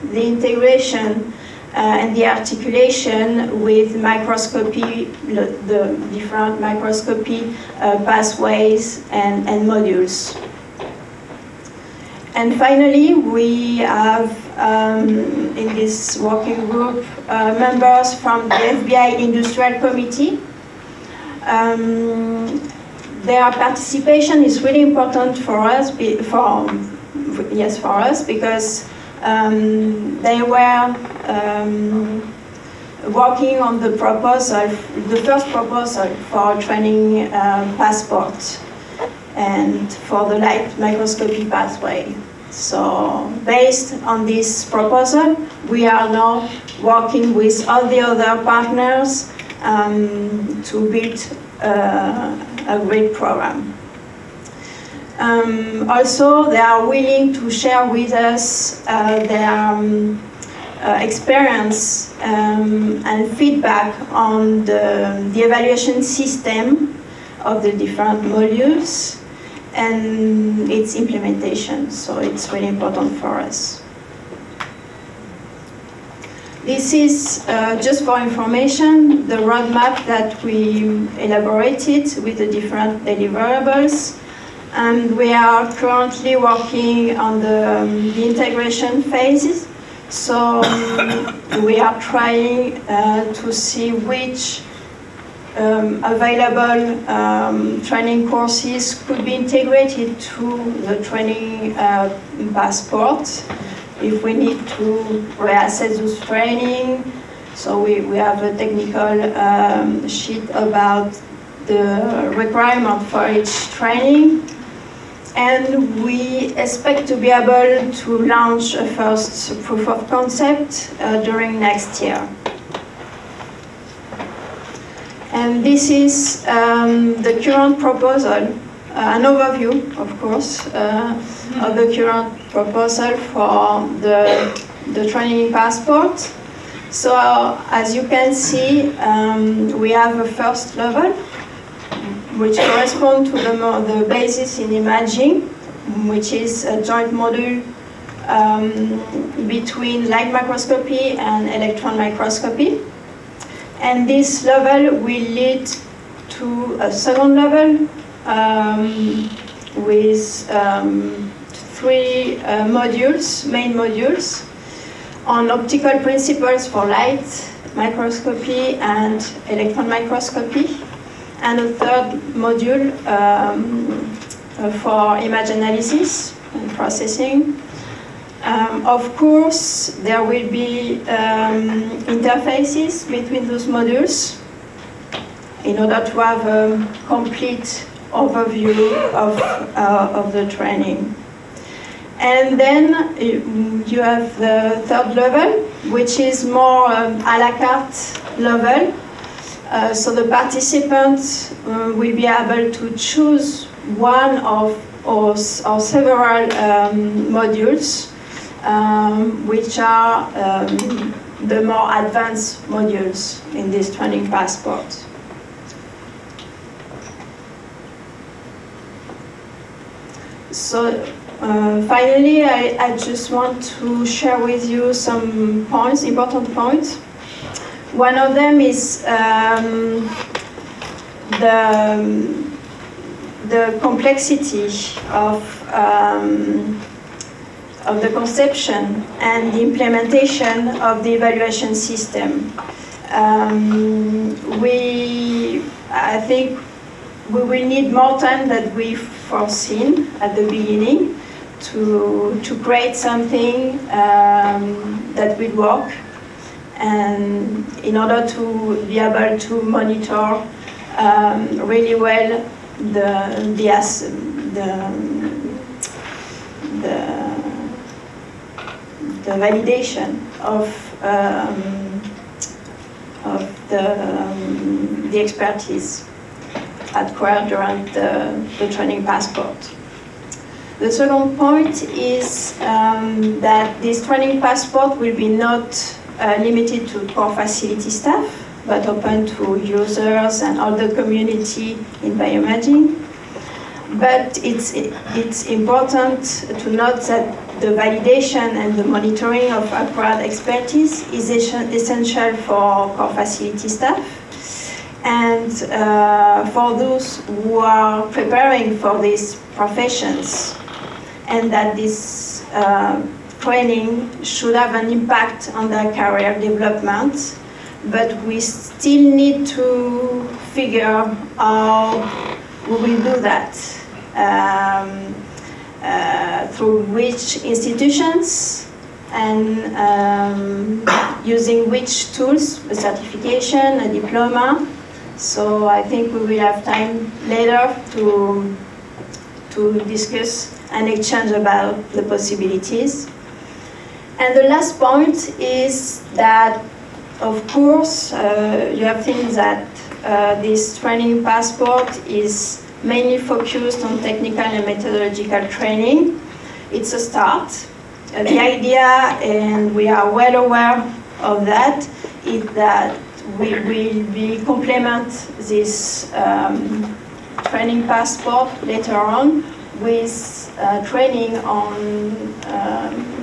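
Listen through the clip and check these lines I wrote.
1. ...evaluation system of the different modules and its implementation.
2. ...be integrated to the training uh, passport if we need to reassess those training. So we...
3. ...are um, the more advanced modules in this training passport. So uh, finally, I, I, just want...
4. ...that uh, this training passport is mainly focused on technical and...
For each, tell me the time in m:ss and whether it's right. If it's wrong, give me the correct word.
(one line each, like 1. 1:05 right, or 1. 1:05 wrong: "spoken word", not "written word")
1. 1:05 right
2. 1:39 right
3. 3:29 right
4. 5:49 right.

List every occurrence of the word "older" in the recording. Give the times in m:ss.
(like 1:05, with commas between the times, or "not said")
not said.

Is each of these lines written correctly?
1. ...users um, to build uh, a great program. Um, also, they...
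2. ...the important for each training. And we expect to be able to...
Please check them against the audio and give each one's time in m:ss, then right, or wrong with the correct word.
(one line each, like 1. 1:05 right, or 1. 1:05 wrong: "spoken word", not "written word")
1. 0:48 wrong: "partners", not "users"
2. 1:51 wrong: "requirement", not "important".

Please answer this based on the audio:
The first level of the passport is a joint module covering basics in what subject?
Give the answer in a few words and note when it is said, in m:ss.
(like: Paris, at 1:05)
imaging, at 2:24.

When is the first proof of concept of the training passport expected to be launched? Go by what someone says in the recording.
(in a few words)
next year.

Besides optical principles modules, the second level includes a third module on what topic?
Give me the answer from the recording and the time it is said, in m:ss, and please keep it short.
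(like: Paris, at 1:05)
image analysis and processing, at 2:55.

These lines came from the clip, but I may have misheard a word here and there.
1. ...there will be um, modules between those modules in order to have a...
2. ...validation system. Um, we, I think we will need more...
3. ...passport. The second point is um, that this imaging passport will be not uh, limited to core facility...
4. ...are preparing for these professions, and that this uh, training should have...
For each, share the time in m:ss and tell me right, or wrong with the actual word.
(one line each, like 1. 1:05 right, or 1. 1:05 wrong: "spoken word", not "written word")
1. 3:00 wrong: "interfaces", not "modules"
2. 4:01 wrong: "evaluation", not "validation"
3. 4:39 wrong: "training", not "imaging"
4. 5:07 right.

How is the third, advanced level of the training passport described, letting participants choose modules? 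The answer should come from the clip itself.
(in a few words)
a la carte.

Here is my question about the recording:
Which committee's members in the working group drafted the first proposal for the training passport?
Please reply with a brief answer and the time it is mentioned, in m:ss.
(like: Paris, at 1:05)
FBI Industrial Committee, at 0:18.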